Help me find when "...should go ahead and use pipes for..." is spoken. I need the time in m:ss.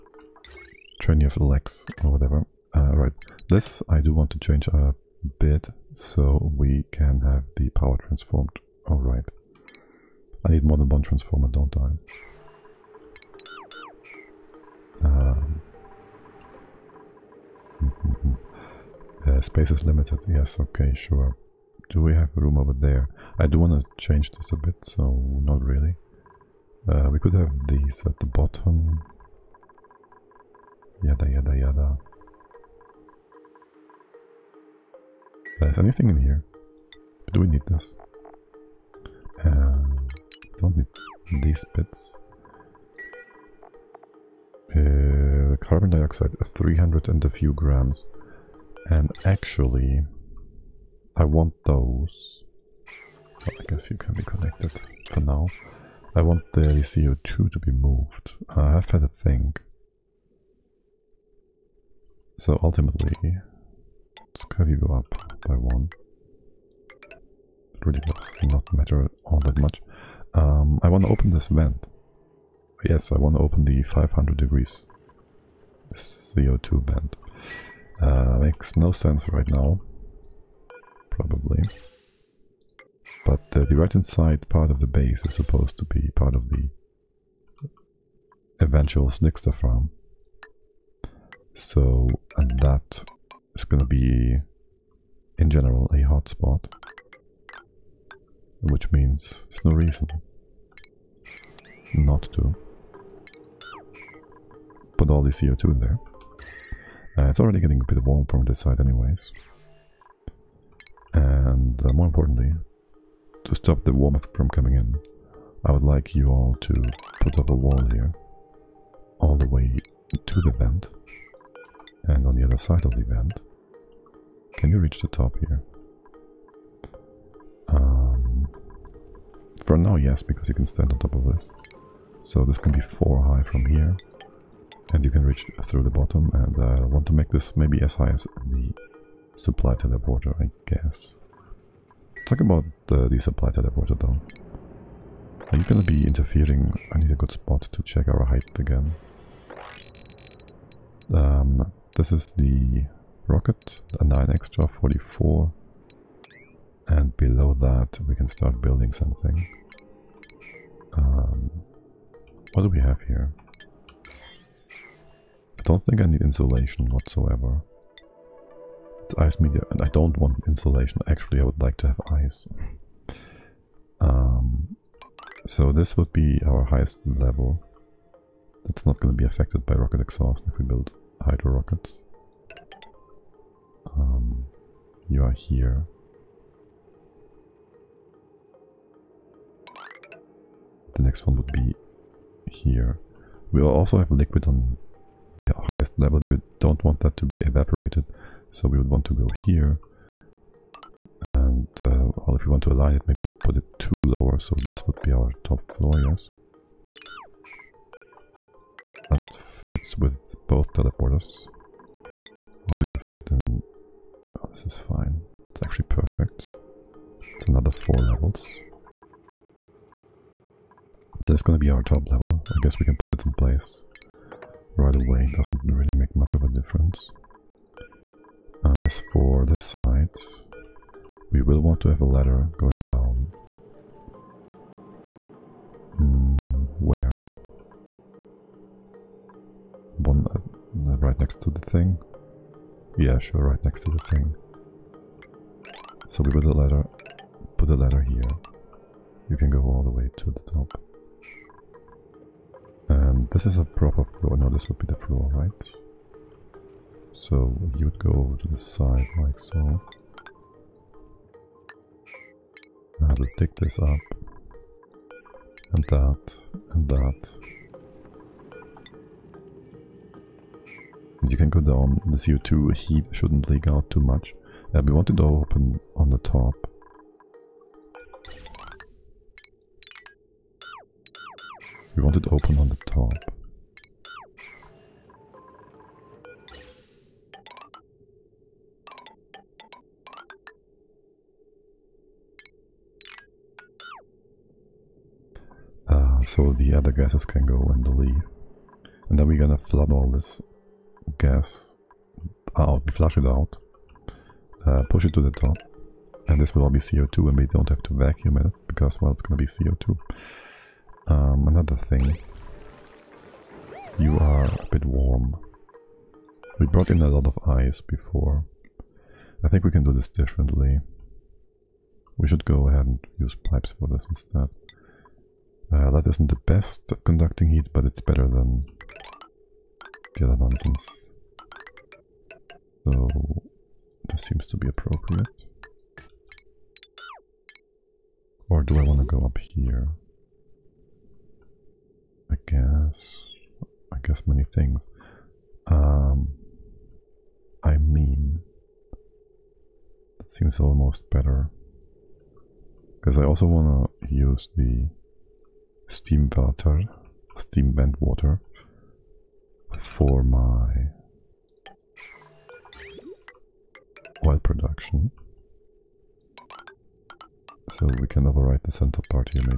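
5:22.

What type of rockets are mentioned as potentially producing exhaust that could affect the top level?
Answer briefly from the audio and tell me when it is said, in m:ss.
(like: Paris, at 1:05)
hydro rockets, at 3:01.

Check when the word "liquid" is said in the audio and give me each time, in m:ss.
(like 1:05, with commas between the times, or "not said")
3:14.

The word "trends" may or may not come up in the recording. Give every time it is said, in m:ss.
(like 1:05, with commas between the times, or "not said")
not said.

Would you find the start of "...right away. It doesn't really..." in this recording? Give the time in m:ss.
3:44.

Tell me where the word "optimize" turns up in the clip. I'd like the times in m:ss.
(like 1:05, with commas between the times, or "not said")
not said.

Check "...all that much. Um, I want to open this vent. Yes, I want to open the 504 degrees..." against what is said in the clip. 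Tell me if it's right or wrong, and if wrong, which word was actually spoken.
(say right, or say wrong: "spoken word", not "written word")
wrong: "500", not "504".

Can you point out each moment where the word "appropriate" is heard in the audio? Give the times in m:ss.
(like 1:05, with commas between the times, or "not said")
5:34.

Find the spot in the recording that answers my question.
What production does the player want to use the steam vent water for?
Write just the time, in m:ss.
6:04.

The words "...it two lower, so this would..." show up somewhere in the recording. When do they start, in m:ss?
3:23.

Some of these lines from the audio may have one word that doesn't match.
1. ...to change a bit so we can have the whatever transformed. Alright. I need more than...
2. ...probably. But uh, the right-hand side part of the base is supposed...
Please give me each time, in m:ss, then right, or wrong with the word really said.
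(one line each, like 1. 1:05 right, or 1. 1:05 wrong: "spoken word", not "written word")
1. 0:04 wrong: "power", not "whatever"
2. 1:21 right.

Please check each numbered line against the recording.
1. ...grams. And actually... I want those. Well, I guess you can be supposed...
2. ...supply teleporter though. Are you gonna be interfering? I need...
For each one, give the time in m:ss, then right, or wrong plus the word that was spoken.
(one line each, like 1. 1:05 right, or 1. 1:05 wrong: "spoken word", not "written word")
1. 0:47 wrong: "connected", not "supposed"
2. 2:23 right.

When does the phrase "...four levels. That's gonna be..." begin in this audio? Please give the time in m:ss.
3:37.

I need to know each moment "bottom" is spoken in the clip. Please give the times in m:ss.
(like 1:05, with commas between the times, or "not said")
0:28, 2:15.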